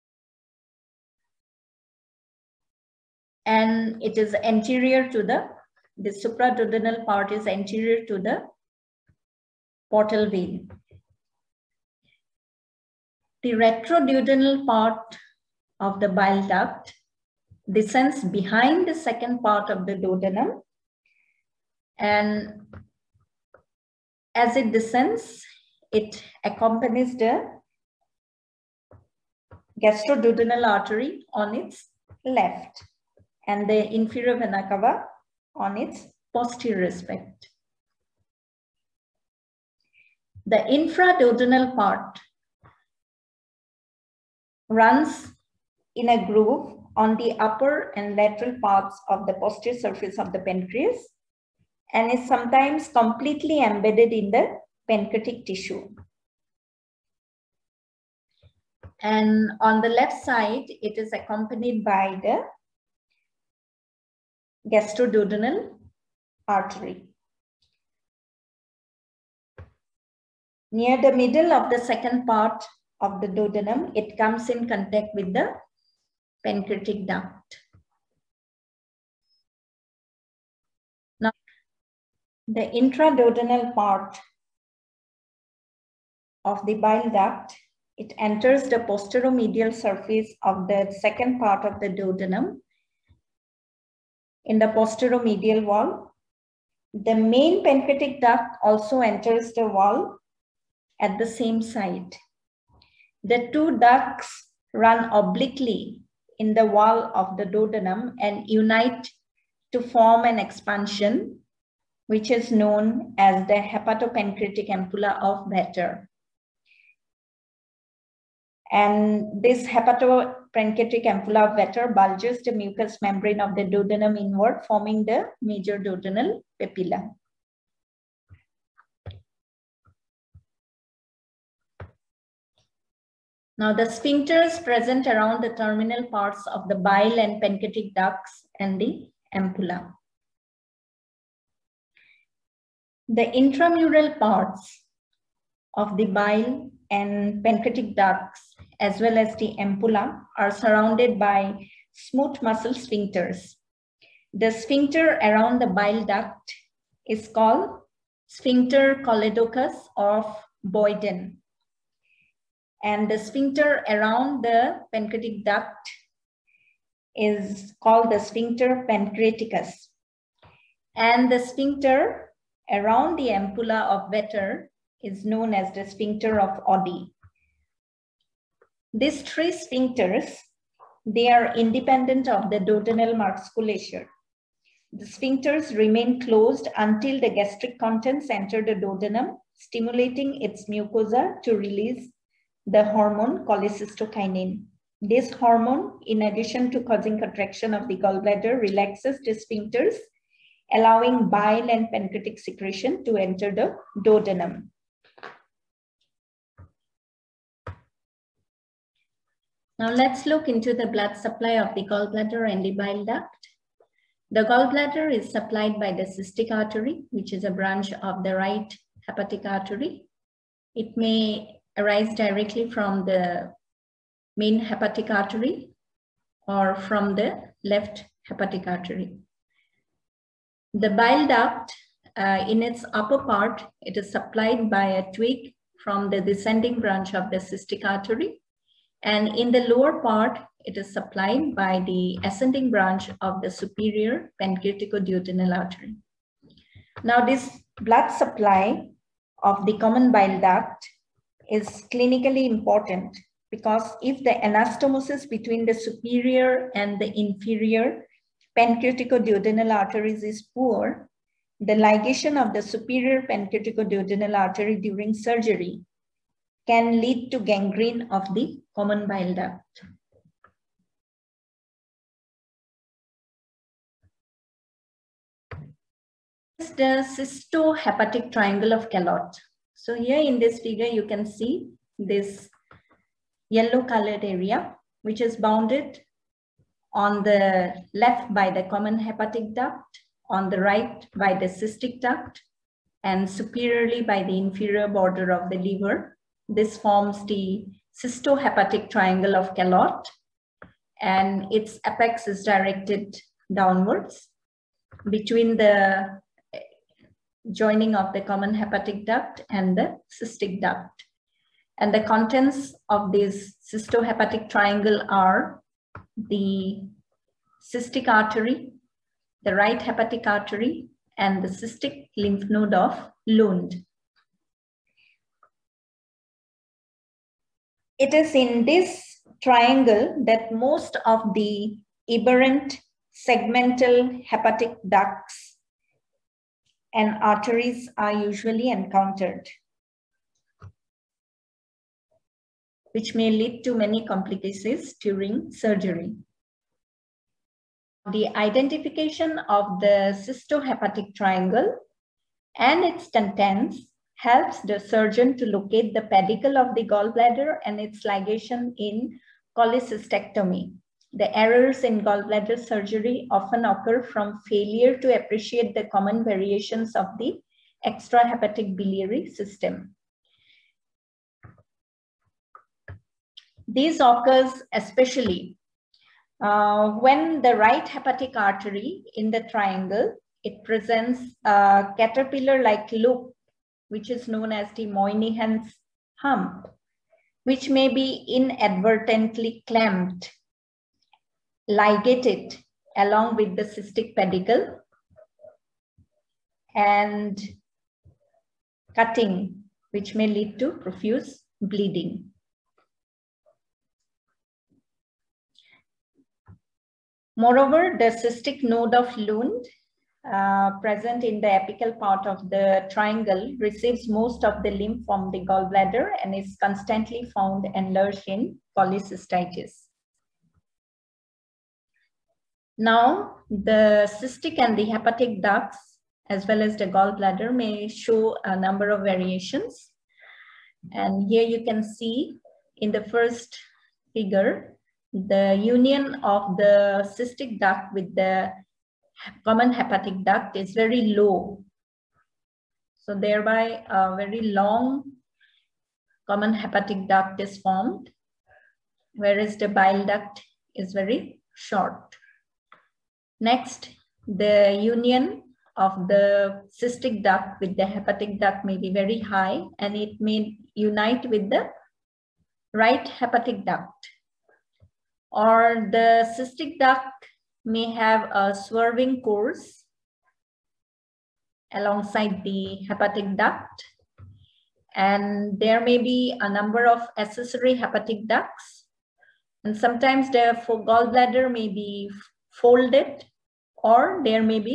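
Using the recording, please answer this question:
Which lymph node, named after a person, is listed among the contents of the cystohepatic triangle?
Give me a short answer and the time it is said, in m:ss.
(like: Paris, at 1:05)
Cystic lymph node of Lund, at 5:21.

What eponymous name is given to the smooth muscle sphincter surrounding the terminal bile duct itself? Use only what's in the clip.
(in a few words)
Sphincter choledochus of Boyden.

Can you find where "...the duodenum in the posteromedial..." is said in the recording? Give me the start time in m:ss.
1:31.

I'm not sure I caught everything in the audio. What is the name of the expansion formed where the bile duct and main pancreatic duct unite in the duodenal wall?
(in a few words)
Hepatopancreatic ampulla of Vater.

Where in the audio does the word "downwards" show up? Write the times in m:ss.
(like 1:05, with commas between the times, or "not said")
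5:03.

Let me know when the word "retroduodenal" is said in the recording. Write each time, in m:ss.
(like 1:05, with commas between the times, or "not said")
0:13.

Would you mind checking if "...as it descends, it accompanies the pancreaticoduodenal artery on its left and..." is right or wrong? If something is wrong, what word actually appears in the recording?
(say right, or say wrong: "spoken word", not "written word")
wrong: "gastroduodenal", not "pancreaticoduodenal".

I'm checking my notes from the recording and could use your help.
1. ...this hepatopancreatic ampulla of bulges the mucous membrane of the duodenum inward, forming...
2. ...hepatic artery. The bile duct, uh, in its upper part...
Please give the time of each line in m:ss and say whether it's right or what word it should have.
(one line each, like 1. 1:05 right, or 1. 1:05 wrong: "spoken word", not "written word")
1. 1:59 right
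2. 3:48 right.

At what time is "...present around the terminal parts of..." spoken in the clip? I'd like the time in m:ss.
2:14.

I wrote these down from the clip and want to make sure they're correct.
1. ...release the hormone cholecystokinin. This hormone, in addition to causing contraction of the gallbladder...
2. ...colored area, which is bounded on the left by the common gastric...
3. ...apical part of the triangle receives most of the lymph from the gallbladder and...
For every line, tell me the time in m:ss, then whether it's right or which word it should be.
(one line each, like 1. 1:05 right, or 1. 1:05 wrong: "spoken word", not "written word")
1. 3:11 right
2. 4:43 wrong: "hepatic", not "gastric"
3. 6:51 right.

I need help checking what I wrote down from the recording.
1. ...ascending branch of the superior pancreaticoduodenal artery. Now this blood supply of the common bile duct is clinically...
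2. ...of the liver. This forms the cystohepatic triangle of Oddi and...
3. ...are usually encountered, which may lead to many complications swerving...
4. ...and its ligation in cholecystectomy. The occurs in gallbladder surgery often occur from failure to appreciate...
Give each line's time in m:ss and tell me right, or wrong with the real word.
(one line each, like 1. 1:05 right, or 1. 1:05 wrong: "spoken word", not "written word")
1. 4:02 right
2. 4:55 wrong: "Calot", not "Oddi"
3. 5:37 wrong: "during", not "swerving"
4. 5:57 wrong: "errors", not "occurs".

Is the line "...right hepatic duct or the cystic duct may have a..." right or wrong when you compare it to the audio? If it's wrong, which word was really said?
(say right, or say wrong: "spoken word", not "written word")
right.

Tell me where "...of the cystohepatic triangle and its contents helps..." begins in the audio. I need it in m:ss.
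5:49.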